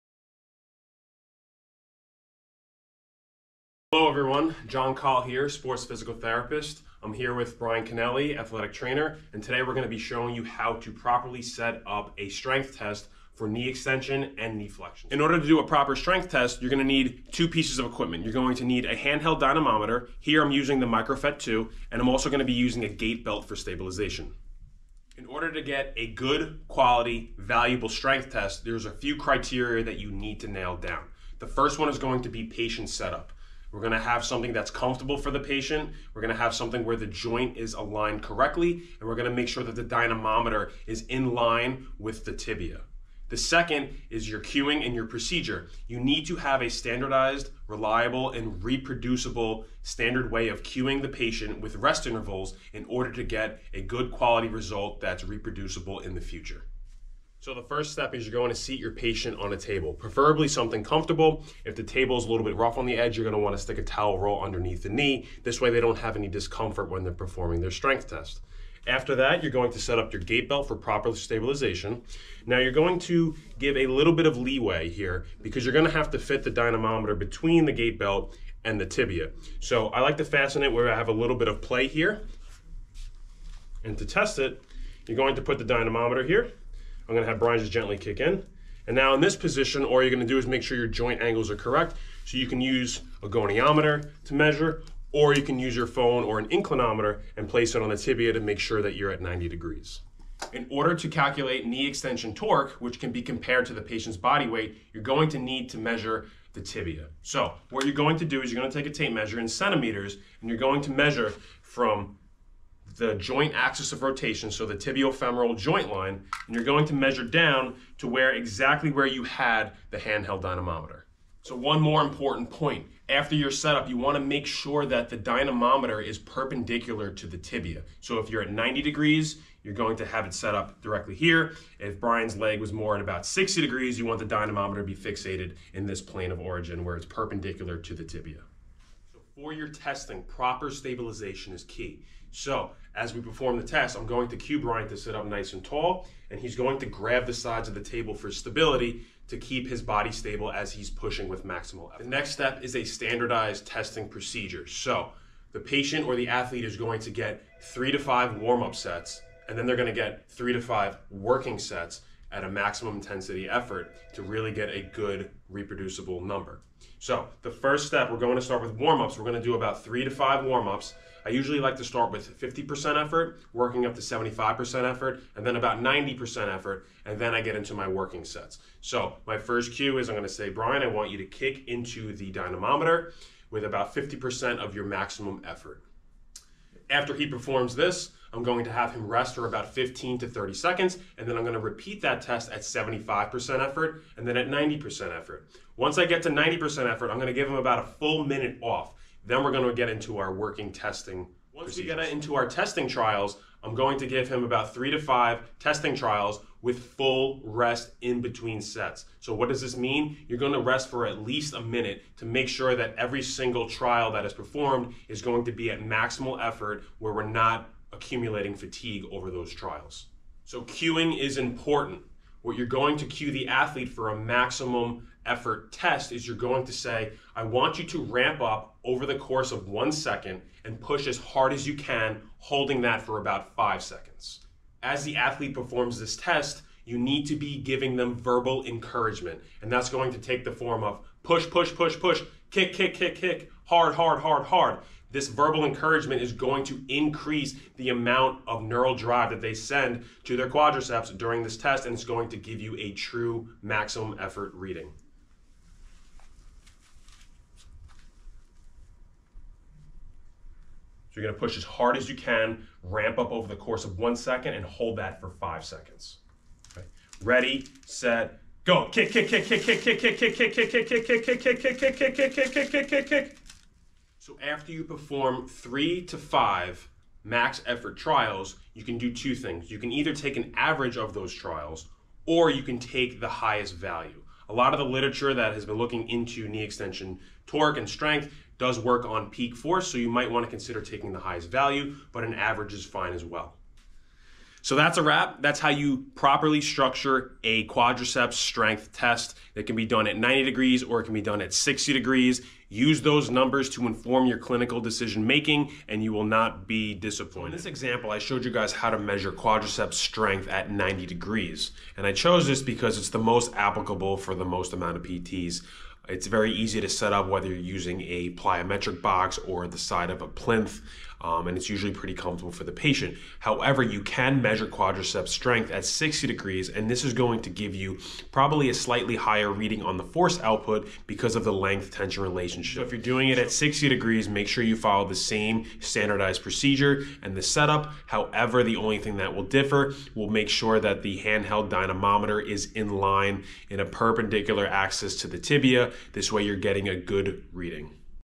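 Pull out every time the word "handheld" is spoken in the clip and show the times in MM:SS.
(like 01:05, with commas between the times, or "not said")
00:18, 01:59, 05:41.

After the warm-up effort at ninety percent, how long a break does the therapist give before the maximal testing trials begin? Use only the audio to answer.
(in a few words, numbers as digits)
1 minute.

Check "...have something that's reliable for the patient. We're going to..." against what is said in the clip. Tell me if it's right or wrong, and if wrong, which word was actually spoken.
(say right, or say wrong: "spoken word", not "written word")
wrong: "comfortable", not "reliable".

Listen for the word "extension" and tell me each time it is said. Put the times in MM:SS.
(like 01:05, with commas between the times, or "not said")
00:13, 01:41.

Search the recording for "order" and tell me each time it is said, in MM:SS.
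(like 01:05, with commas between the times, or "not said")
00:15, 00:25, 00:52, 01:40.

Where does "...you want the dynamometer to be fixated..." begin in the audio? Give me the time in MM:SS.
02:13.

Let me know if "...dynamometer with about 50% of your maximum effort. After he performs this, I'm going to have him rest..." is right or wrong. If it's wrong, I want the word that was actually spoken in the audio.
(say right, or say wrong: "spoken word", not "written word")
right.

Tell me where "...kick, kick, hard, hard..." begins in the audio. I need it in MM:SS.
04:02.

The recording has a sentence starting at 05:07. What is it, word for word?
In this example, I showed you guys how to measure quadriceps strength at 90 degrees.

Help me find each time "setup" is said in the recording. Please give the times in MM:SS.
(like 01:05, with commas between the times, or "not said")
00:32, 02:03, 05:37.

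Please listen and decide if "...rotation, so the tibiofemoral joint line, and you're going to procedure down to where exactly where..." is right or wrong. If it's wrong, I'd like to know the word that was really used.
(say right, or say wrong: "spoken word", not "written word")
wrong: "measure", not "procedure".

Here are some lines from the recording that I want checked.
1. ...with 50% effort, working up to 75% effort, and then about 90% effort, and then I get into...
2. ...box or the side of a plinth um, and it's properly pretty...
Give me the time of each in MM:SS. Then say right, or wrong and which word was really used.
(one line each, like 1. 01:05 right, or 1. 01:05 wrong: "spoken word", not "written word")
1. 02:52 right
2. 05:19 wrong: "usually", not "properly".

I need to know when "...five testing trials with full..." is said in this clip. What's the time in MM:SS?
03:24.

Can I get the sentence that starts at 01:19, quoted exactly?
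So I like to fasten it where I have a little bit of play here.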